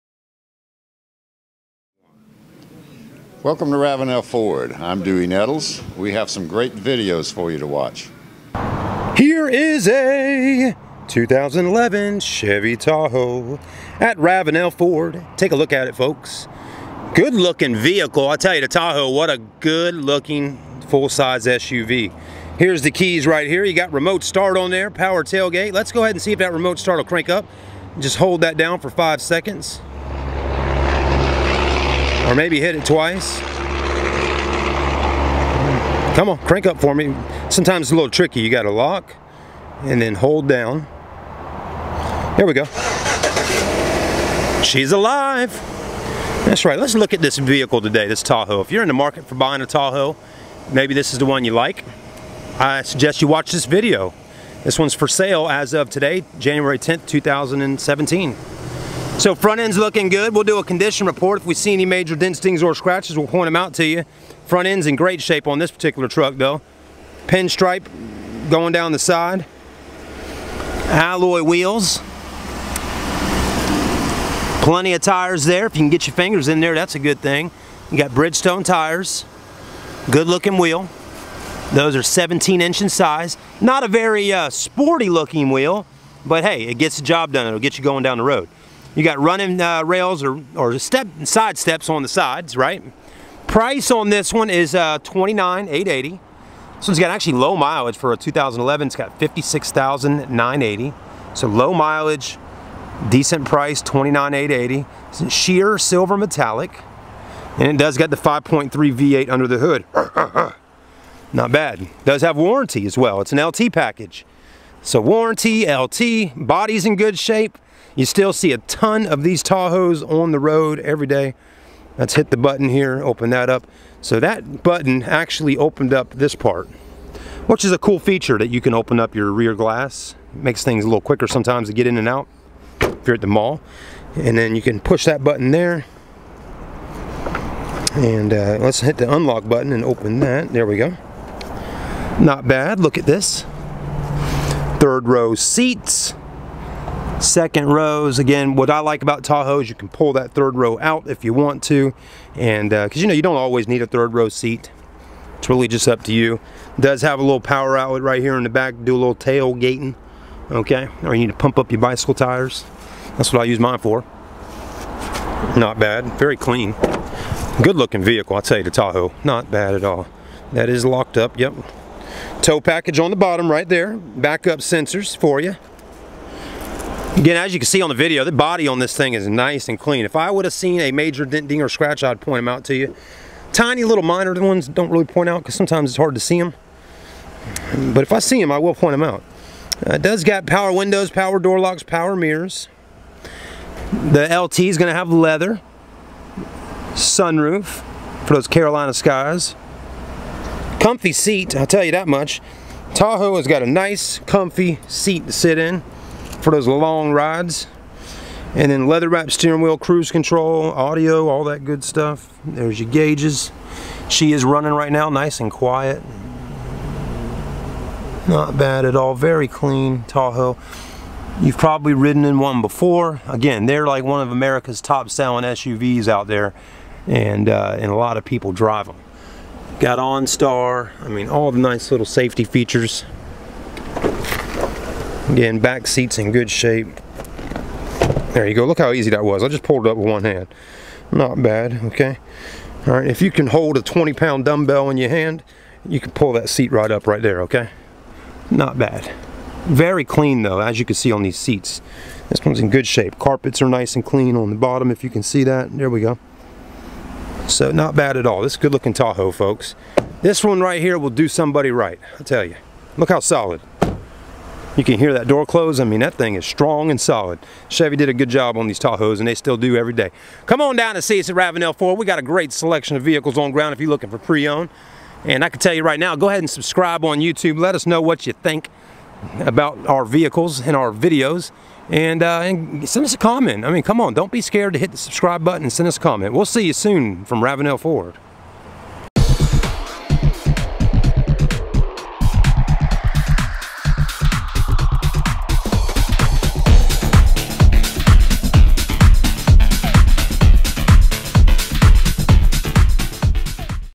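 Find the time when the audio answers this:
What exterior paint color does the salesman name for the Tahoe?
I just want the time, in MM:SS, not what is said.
01:45.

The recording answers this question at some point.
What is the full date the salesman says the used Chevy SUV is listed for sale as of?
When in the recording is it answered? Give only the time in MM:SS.
00:56.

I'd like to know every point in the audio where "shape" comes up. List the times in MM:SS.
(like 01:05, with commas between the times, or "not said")
01:05, 01:57, 03:56, 04:12.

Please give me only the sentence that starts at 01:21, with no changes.
Those are 17 inch in size.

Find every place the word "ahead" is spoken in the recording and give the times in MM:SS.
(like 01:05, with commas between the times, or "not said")
00:26, 04:36.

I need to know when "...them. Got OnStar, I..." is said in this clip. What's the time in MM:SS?
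03:48.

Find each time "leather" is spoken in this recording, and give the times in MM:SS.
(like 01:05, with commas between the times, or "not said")
03:15, 03:28.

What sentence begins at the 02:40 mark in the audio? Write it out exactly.
Okay, or you need to pump up your bicycle tires.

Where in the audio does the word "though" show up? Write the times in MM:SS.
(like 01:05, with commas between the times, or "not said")
01:06, 04:10.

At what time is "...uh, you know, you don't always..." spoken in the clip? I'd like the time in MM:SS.
02:32.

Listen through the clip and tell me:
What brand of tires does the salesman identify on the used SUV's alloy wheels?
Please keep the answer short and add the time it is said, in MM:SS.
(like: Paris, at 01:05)
Bridgestone, at 01:18.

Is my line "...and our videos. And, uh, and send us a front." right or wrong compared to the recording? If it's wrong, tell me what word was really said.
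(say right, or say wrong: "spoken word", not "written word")
wrong: "comment", not "front".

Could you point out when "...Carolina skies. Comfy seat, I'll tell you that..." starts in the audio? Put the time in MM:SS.
03:18.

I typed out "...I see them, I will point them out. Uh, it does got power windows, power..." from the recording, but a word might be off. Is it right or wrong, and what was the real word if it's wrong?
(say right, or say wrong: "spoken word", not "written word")
right.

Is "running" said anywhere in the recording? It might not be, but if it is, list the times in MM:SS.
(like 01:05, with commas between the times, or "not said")
01:29, 03:34.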